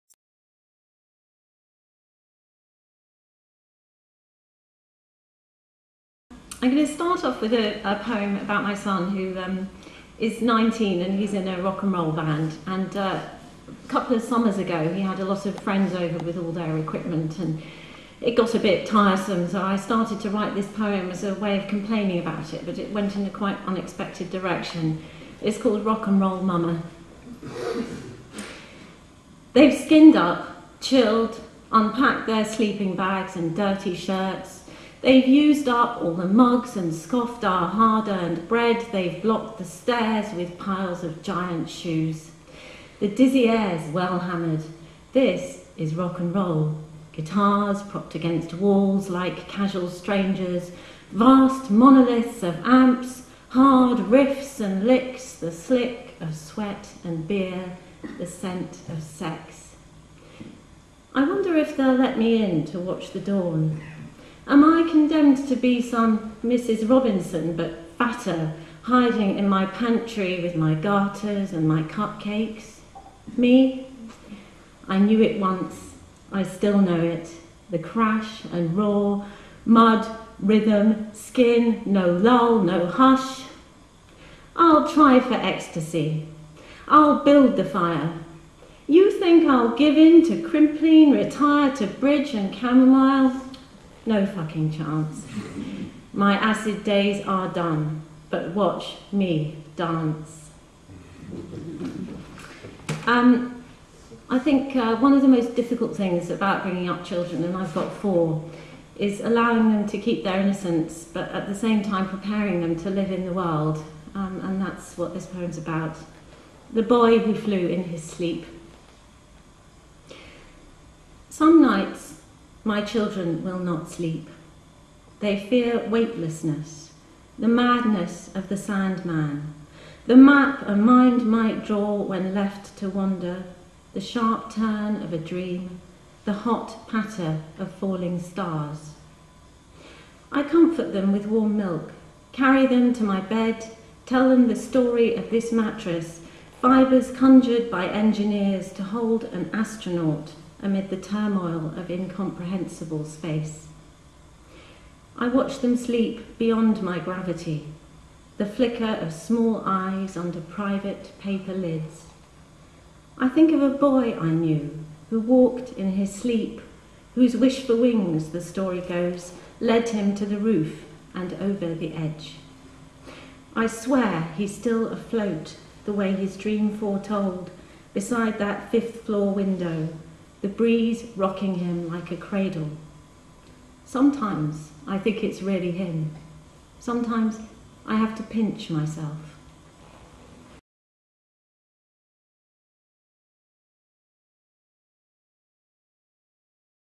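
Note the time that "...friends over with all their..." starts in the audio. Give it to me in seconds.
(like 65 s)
15 s.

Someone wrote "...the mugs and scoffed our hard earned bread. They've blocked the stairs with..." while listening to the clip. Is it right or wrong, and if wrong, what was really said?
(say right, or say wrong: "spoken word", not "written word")
right.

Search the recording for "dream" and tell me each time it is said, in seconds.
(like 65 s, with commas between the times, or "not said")
135 s, 176 s.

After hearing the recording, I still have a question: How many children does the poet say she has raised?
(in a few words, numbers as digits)
4.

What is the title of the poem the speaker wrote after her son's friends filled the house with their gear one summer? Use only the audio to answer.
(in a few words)
Rock and Roll Mama.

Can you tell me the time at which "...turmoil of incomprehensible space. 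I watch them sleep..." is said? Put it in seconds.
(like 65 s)
150 s.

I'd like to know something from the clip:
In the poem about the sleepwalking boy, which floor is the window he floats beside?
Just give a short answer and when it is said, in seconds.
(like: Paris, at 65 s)
fifth floor, at 178 s.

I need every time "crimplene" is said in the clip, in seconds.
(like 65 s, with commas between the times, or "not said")
90 s.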